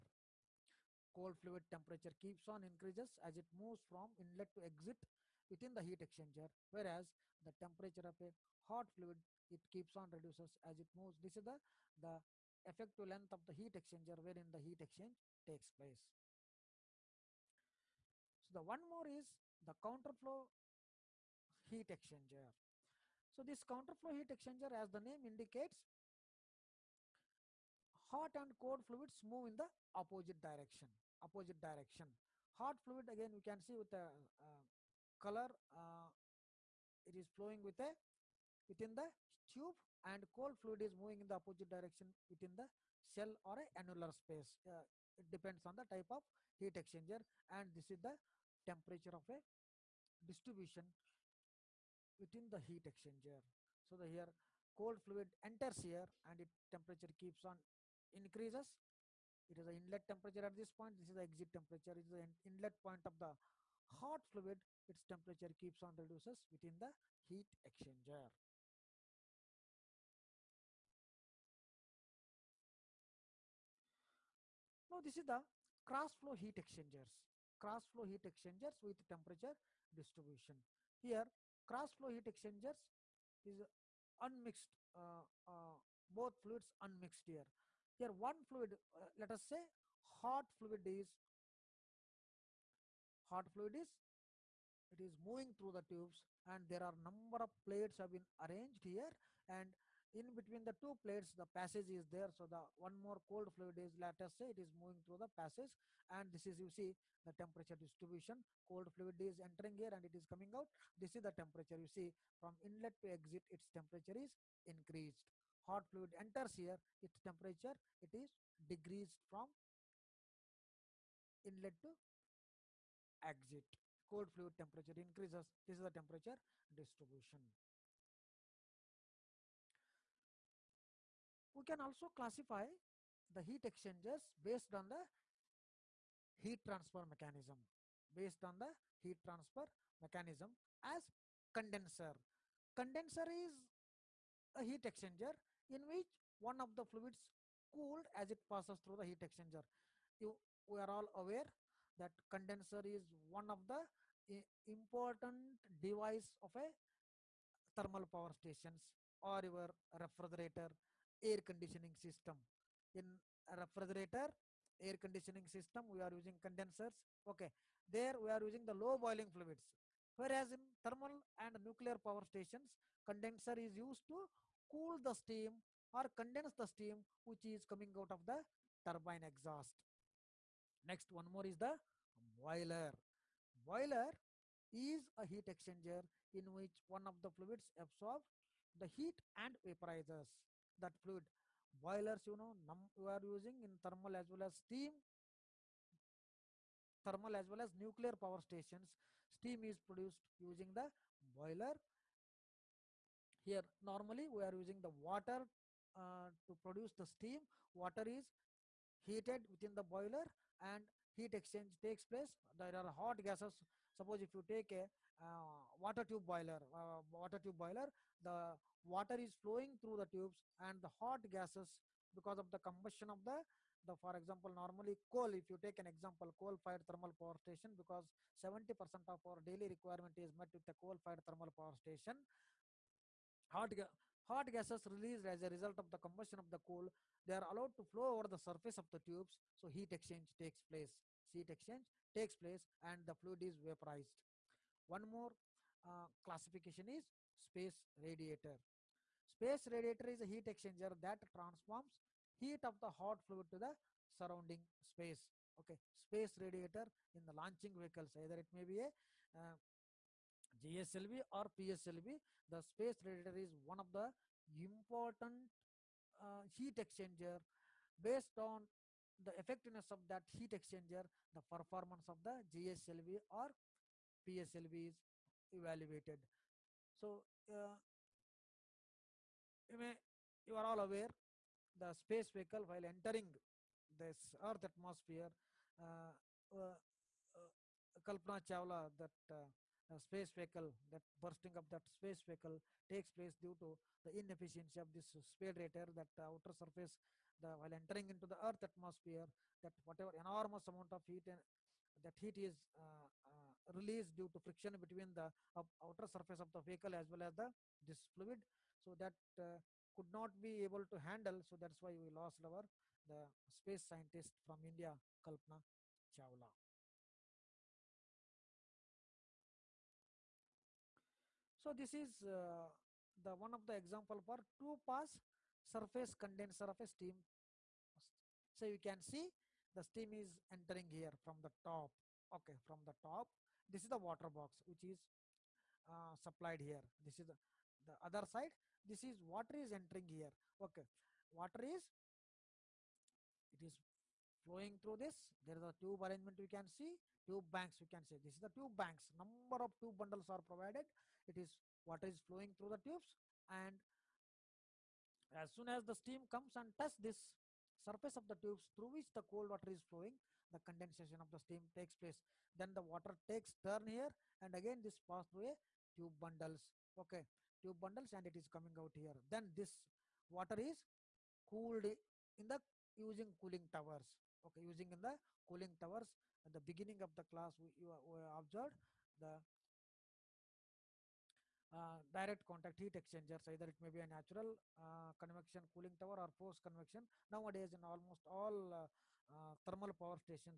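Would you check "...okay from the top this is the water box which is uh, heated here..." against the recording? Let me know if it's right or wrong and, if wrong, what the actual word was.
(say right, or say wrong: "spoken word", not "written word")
wrong: "supplied", not "heated".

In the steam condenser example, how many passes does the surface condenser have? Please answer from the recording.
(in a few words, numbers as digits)
2.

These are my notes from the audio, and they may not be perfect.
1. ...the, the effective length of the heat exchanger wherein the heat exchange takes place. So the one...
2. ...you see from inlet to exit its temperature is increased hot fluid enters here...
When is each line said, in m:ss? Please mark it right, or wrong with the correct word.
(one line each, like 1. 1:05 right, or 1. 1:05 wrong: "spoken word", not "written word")
1. 0:11 right
2. 1:51 right.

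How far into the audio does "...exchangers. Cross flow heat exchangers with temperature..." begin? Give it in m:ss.
1:16.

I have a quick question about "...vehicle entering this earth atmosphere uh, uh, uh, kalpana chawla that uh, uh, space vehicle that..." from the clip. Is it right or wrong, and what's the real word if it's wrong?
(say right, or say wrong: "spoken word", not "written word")
wrong: "while", not "vehicle".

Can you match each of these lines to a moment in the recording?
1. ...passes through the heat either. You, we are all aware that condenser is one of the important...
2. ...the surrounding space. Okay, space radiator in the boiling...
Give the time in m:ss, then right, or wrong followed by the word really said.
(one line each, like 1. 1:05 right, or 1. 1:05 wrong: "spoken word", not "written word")
1. 2:28 wrong: "exchanger", not "either"
2. 4:13 wrong: "launching", not "boiling".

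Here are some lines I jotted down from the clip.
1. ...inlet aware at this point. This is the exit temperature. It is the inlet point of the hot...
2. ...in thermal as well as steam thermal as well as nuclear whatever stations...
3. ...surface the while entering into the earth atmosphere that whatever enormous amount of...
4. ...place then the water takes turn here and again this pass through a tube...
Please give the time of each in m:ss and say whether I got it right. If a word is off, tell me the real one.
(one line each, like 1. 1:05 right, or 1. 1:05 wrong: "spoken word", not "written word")
1. 0:59 wrong: "temperature", not "aware"
2. 3:13 wrong: "power", not "whatever"
3. 4:56 right
4. 6:01 right.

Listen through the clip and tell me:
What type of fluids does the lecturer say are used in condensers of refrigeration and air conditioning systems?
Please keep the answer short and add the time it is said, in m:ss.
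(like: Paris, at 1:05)
low boiling fluids, at 2:48.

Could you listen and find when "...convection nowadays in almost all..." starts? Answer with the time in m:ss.
6:26.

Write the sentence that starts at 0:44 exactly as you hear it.
Uh, it depends on the type of heat exchanger and this is the temperature of a distribution within the heat exchanger.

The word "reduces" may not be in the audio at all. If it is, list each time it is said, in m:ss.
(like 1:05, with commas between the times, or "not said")
0:10, 1:05.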